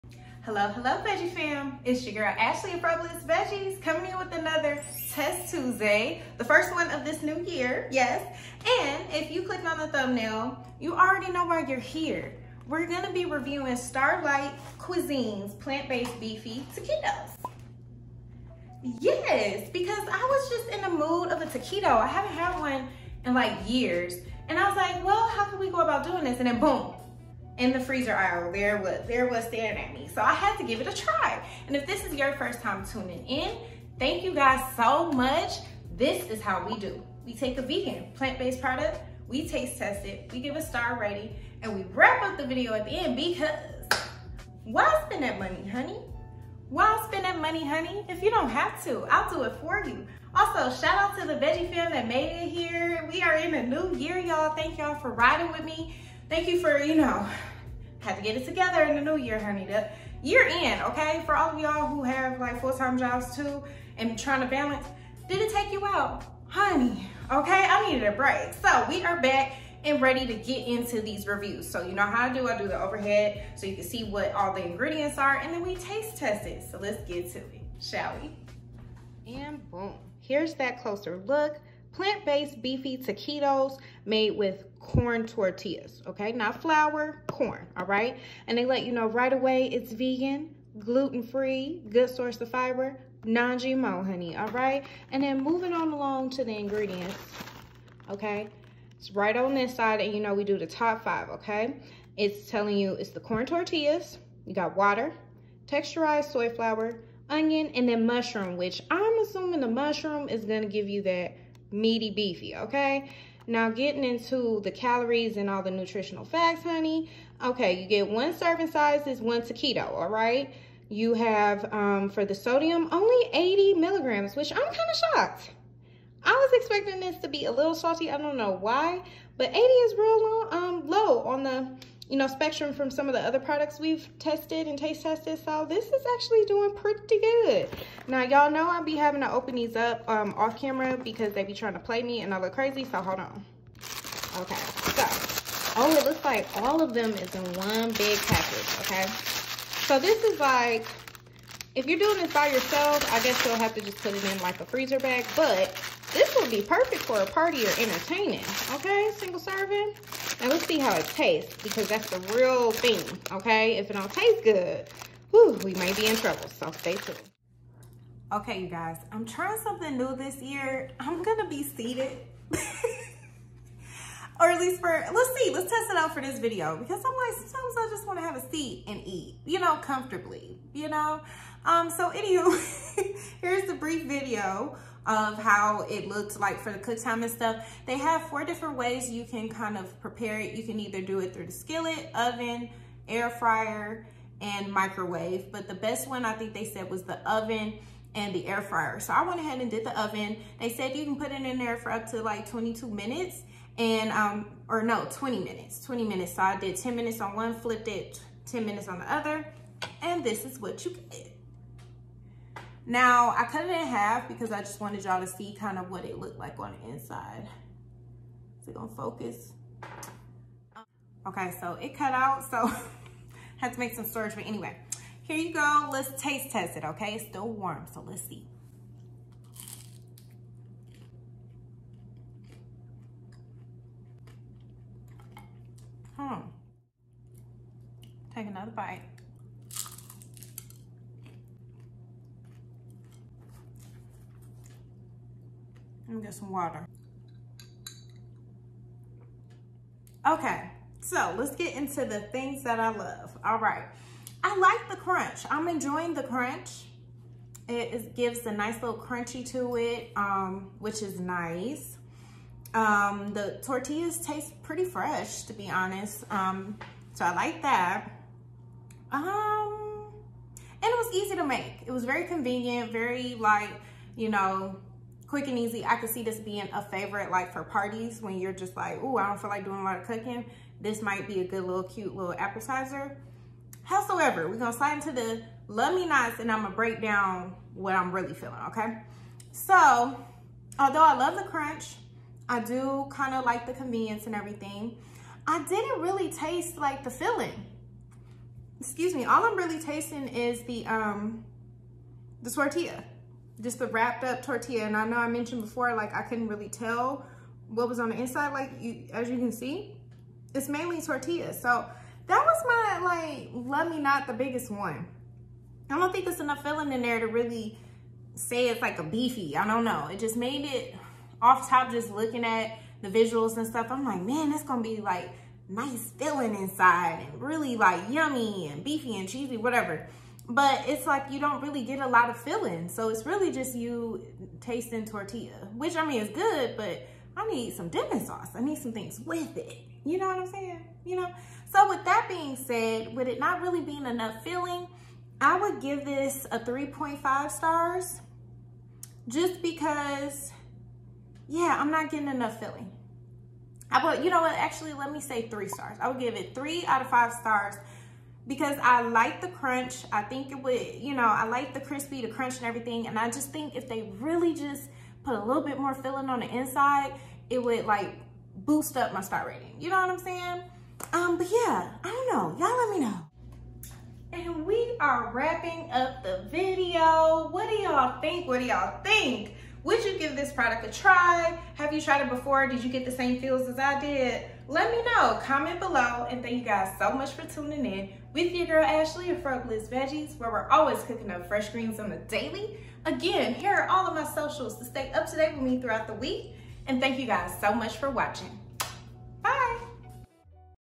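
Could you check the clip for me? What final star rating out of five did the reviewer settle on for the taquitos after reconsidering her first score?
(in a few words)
3 stars.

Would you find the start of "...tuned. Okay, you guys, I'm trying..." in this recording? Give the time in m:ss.
2:46.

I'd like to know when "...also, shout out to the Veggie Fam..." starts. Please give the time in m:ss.
0:50.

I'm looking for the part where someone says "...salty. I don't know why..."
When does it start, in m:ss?
2:07.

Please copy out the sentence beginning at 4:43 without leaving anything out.
Howsoever, we're gonna slide into the love me nots and I'm gonna break down what I'm really feeling, okay?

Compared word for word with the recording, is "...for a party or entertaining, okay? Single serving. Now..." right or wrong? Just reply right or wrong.
right.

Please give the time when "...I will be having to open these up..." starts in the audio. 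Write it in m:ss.
2:18.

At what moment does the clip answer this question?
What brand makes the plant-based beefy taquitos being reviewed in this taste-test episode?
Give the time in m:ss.
0:13.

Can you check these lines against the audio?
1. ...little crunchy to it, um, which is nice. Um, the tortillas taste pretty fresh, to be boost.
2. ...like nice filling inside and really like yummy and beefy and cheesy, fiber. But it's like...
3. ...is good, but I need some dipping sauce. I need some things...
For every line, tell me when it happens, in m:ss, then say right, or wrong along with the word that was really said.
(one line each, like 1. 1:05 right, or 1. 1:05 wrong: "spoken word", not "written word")
1. 4:18 wrong: "honest", not "boost"
2. 5:25 wrong: "whatever", not "fiber"
3. 5:36 right.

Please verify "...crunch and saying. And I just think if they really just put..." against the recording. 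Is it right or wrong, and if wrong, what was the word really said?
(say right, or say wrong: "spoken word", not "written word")
wrong: "everything", not "saying".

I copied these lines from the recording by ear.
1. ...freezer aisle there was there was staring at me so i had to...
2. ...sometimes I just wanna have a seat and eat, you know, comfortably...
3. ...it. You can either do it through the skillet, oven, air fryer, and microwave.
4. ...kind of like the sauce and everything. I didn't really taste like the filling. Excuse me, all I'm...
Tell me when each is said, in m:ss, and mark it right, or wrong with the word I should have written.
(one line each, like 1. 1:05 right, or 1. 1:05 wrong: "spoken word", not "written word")
1. 0:27 right
2. 2:57 right
3. 3:10 right
4. 4:53 wrong: "convenience", not "sauce".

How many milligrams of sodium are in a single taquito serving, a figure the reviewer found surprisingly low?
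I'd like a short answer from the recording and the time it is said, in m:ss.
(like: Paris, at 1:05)
80 milligrams, at 2:03.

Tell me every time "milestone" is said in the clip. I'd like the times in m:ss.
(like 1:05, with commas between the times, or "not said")
not said.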